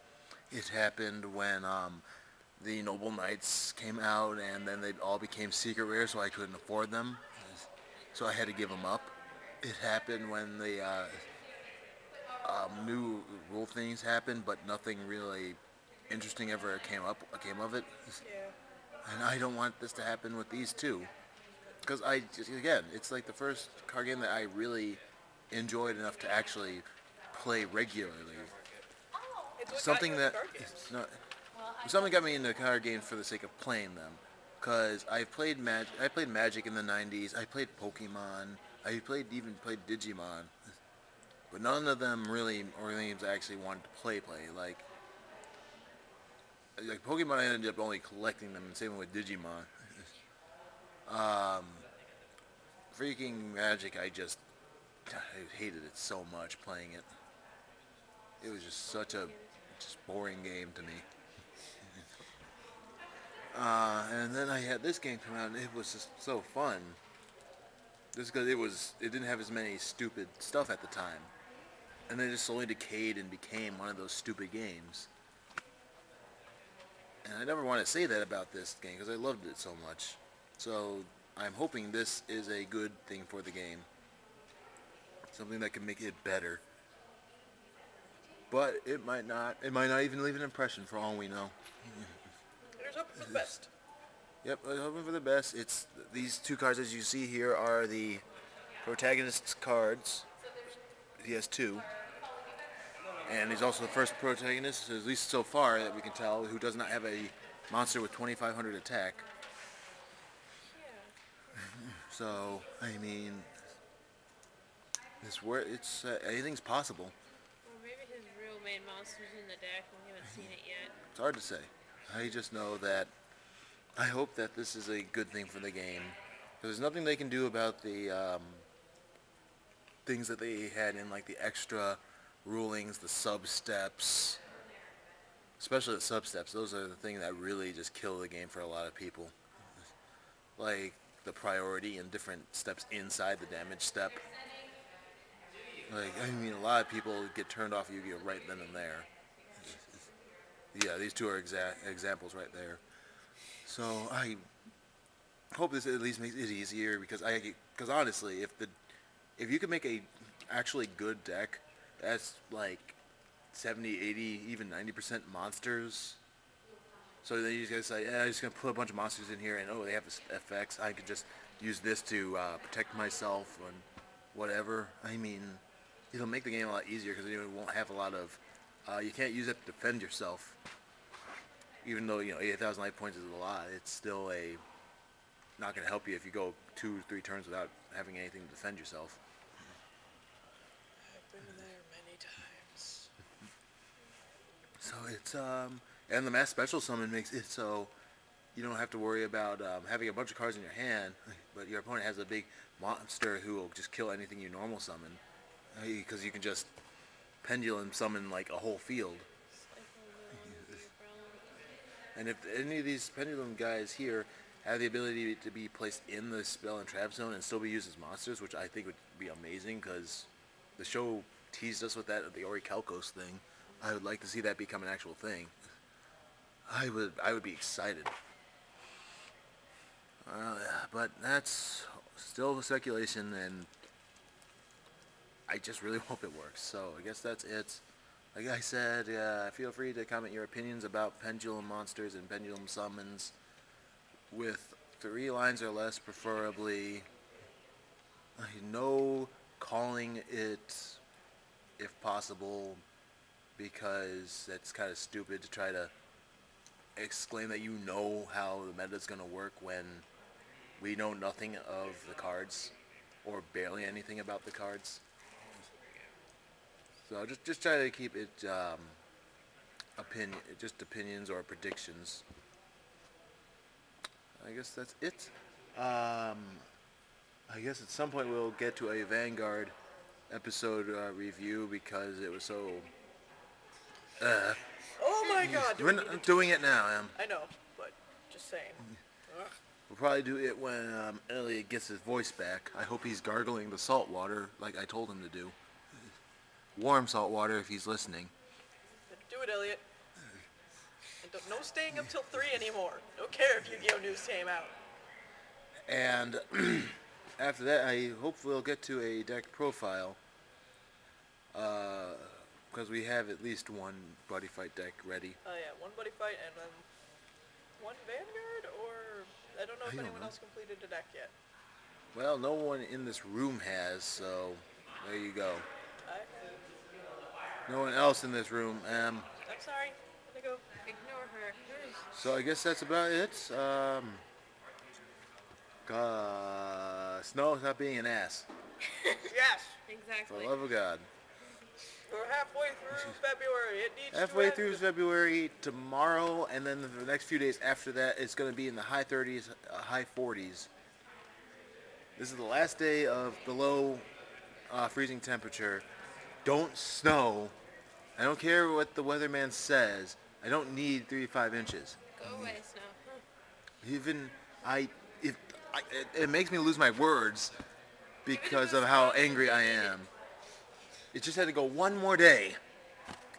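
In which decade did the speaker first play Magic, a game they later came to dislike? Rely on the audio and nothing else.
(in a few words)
the '90s.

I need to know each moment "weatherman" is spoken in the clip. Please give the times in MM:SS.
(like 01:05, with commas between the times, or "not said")
05:59.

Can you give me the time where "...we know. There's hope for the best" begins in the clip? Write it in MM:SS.
01:31.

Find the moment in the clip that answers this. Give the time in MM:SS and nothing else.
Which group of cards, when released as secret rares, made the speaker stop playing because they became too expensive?
00:02.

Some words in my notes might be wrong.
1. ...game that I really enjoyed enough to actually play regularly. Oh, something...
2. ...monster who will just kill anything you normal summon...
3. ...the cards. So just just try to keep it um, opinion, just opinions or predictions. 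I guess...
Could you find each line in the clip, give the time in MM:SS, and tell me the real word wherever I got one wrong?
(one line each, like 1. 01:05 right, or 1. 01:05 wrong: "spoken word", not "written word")
1. 00:24 right
2. 03:22 right
3. 04:24 right.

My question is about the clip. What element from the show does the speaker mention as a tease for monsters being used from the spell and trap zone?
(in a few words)
the Orichalcos.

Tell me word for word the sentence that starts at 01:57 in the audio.
Well, maybe his real main monster's in the deck, and we haven't seen it yet.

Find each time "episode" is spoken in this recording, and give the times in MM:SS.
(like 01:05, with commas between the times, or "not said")
04:40.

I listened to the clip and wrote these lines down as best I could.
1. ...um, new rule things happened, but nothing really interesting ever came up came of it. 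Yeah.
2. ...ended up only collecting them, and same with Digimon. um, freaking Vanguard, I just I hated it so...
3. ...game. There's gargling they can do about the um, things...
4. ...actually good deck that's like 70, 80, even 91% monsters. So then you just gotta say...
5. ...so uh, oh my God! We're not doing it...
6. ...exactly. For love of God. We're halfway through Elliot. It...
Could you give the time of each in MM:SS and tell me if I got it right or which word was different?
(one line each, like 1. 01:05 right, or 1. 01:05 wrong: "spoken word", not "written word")
1. 00:12 right
2. 00:47 wrong: "Magic", not "Vanguard"
3. 02:05 wrong: "nothing", not "gargling"
4. 02:40 wrong: "90", not "91"
5. 04:42 right
6. 05:39 wrong: "February", not "Elliot".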